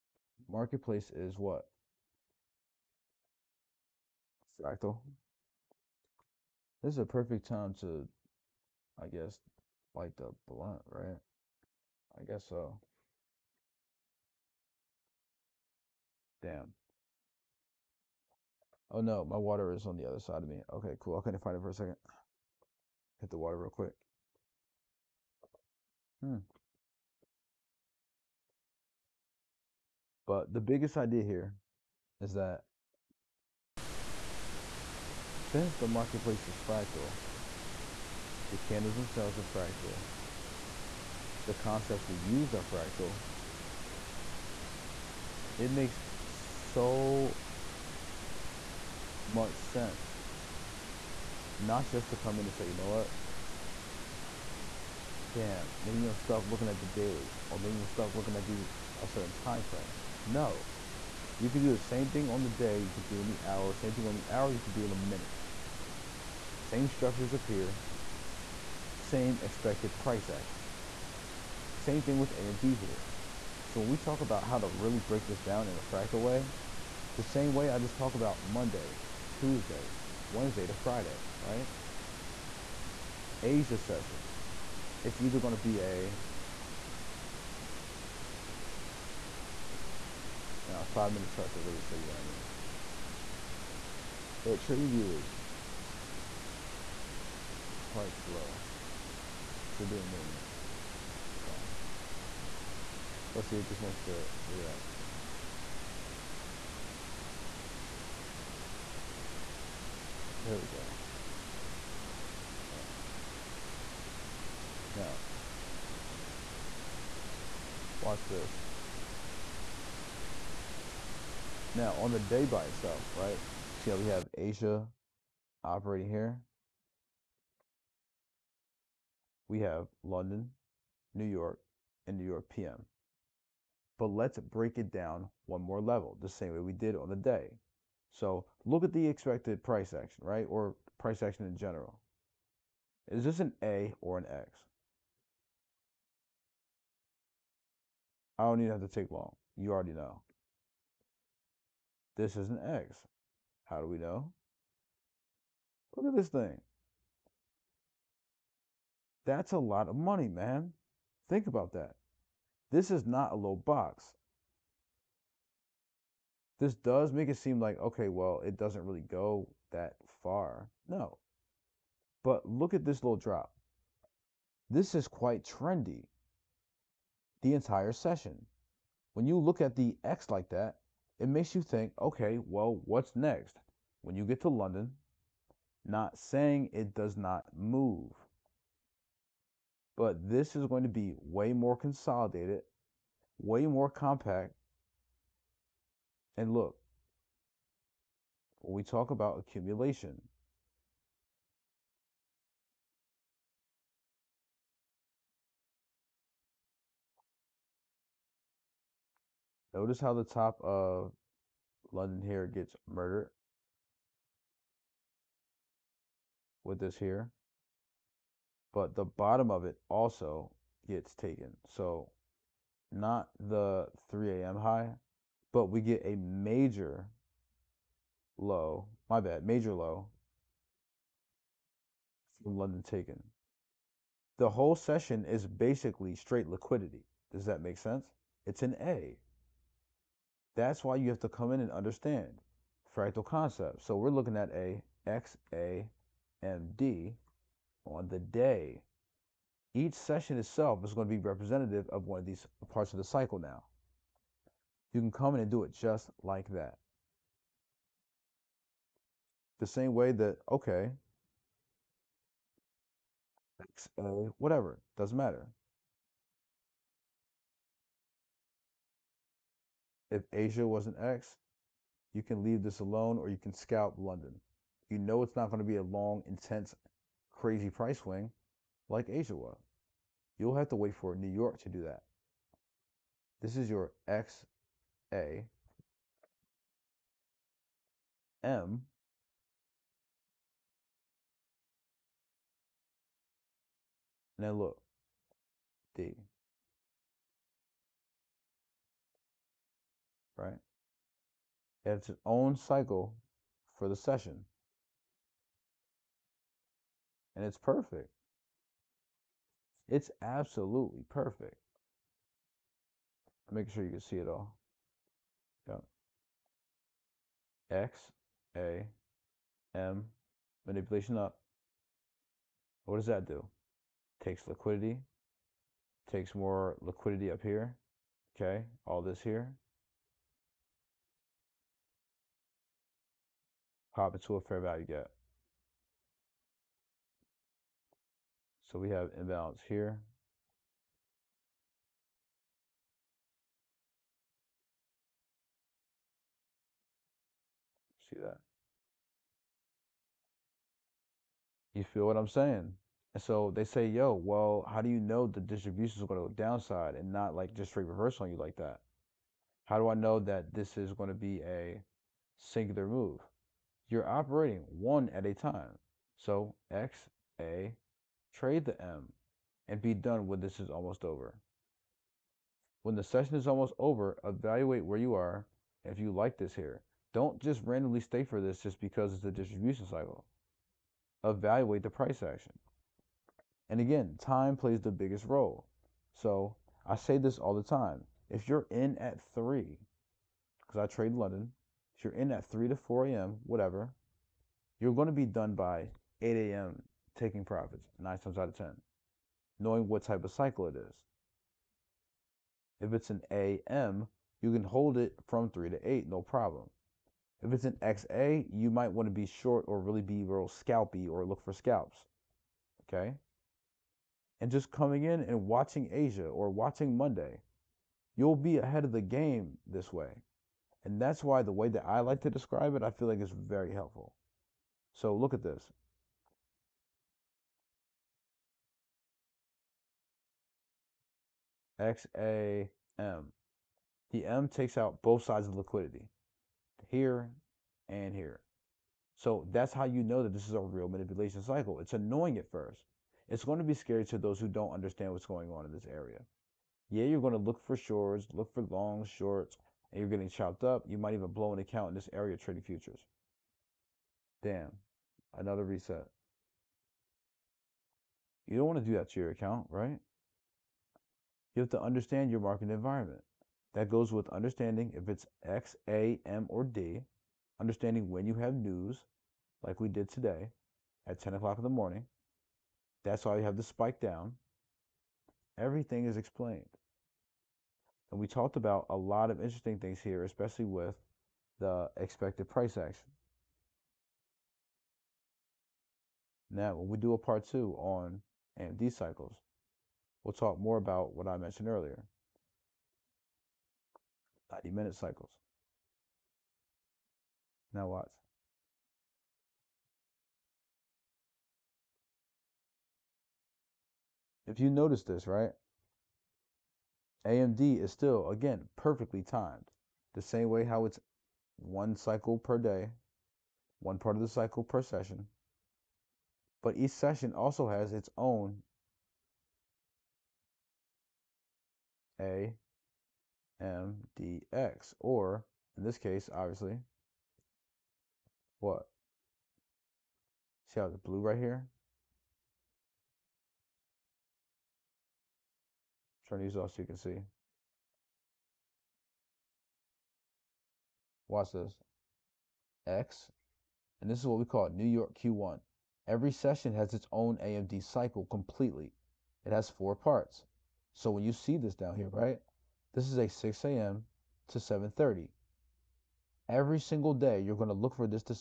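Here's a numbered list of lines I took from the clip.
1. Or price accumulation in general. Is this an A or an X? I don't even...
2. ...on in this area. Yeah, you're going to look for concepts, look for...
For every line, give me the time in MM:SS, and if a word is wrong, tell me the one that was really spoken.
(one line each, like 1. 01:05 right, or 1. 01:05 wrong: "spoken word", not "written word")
1. 02:20 wrong: "action", not "accumulation"
2. 07:25 wrong: "shorts", not "concepts".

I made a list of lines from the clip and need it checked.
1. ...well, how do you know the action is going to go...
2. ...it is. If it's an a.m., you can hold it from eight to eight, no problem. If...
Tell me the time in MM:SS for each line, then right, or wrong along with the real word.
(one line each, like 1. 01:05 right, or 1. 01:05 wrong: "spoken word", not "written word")
1. 05:54 wrong: "distribution", not "action"
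2. 06:40 wrong: "three", not "eight".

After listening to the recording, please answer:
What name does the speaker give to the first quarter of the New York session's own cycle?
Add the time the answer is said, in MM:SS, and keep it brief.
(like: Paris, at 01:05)
New York Q1, at 09:04.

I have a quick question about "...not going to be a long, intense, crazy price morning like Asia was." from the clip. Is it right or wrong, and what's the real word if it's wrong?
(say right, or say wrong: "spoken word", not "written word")
wrong: "swing", not "morning".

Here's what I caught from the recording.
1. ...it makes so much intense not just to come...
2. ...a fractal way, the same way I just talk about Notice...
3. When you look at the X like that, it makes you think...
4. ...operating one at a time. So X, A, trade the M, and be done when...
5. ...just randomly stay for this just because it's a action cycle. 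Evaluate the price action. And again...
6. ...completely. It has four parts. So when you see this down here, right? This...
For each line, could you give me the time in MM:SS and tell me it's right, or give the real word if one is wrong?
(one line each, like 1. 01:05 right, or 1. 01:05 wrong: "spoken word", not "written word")
1. 00:45 wrong: "sense", not "intense"
2. 01:15 wrong: "Monday", not "Notice"
3. 02:59 right
4. 06:04 right
5. 06:17 wrong: "distribution", not "action"
6. 09:08 right.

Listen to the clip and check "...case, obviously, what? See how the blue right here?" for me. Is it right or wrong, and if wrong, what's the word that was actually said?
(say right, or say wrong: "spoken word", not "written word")
right.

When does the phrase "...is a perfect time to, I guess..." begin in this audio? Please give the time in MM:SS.
00:06.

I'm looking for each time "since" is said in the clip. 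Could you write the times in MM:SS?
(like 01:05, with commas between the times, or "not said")
00:35.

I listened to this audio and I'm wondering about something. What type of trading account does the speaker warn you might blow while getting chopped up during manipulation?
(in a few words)
Futures.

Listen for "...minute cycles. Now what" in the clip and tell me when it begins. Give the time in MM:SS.
08:14.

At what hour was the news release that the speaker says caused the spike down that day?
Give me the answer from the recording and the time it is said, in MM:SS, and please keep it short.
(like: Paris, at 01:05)
10 o'clock, at 07:51.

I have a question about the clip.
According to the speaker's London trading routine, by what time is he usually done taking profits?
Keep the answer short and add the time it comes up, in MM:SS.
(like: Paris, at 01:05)
8 a.m., at 06:36.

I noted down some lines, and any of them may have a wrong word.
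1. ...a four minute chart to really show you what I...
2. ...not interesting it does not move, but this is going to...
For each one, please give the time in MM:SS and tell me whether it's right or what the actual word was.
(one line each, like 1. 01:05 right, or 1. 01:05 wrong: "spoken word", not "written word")
1. 01:30 wrong: "five", not "four"
2. 03:05 wrong: "saying", not "interesting".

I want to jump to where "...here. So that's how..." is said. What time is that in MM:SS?
07:18.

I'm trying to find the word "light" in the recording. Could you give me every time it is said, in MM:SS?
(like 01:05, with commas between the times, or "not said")
00:09.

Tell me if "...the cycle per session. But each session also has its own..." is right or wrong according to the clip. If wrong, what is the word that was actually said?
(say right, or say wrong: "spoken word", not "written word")
right.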